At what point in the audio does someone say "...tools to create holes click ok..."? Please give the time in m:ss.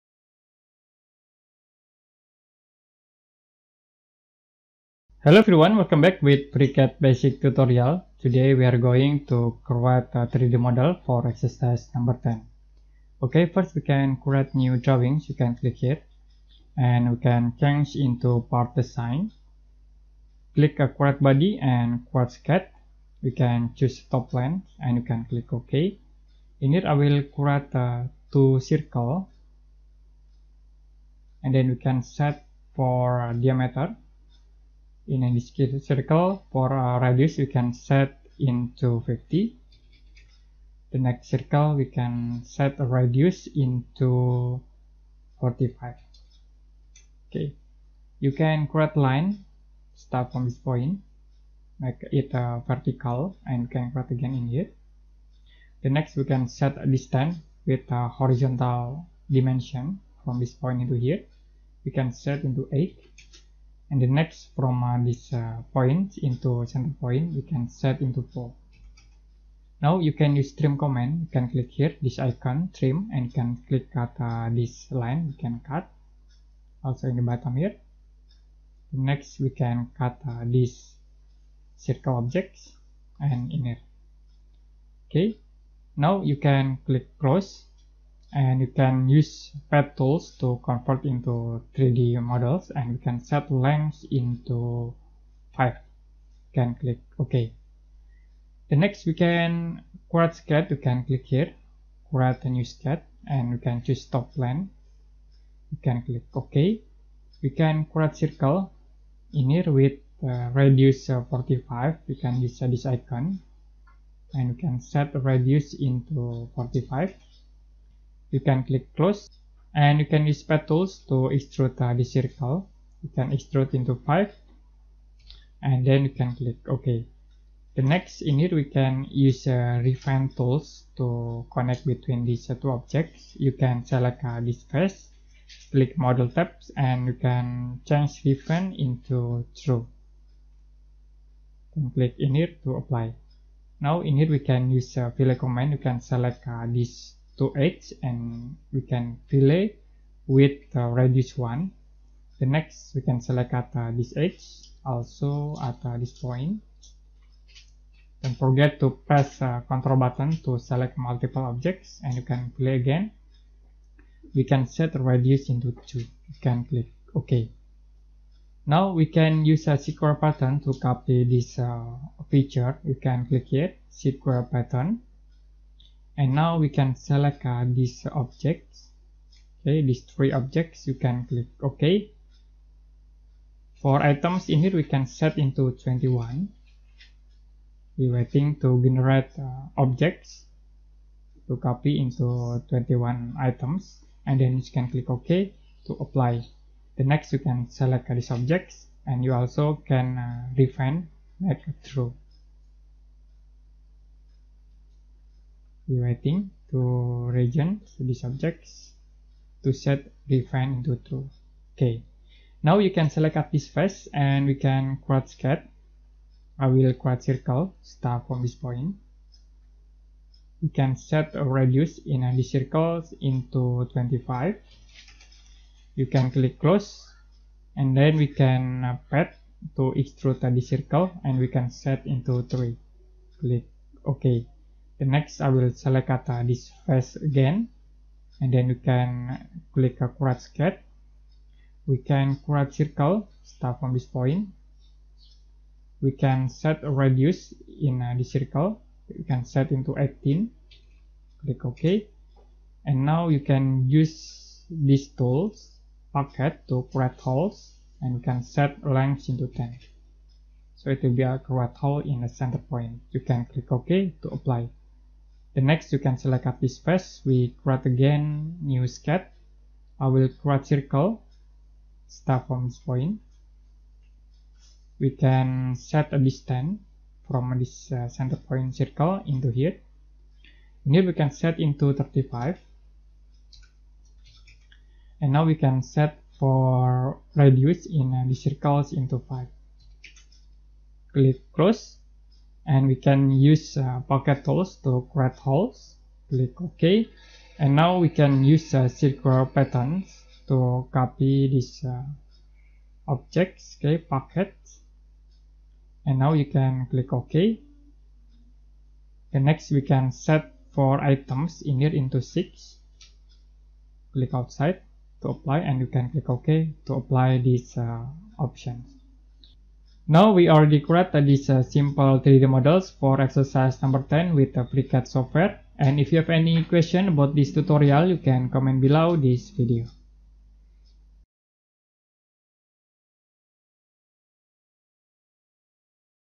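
4:54.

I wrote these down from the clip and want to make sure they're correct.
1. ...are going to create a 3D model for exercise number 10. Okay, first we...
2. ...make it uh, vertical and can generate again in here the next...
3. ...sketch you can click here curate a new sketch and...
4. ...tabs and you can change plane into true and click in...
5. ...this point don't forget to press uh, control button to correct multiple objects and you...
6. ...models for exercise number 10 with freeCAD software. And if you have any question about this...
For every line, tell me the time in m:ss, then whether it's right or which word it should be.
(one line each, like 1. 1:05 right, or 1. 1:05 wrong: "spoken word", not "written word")
1. 0:08 right
2. 0:51 wrong: "create", not "generate"
3. 1:40 wrong: "create", not "curate"
4. 2:16 wrong: "refine", not "plane"
5. 2:35 wrong: "select", not "correct"
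6. 5:22 right.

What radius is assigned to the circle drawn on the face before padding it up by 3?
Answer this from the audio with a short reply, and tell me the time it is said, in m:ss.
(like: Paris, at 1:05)
25, at 3:43.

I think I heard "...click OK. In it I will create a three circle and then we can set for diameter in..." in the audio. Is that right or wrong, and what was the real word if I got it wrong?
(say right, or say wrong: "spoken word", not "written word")
wrong: "two", not "three".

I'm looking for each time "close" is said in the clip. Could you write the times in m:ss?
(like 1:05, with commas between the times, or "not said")
1:58, 3:46, 4:51.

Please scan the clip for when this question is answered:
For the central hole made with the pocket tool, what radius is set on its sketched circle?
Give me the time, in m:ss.
4:09.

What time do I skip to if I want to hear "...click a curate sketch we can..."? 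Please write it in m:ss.
3:59.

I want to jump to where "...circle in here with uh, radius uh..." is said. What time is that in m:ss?
1:48.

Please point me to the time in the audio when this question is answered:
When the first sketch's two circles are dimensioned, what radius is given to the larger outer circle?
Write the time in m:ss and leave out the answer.
0:39.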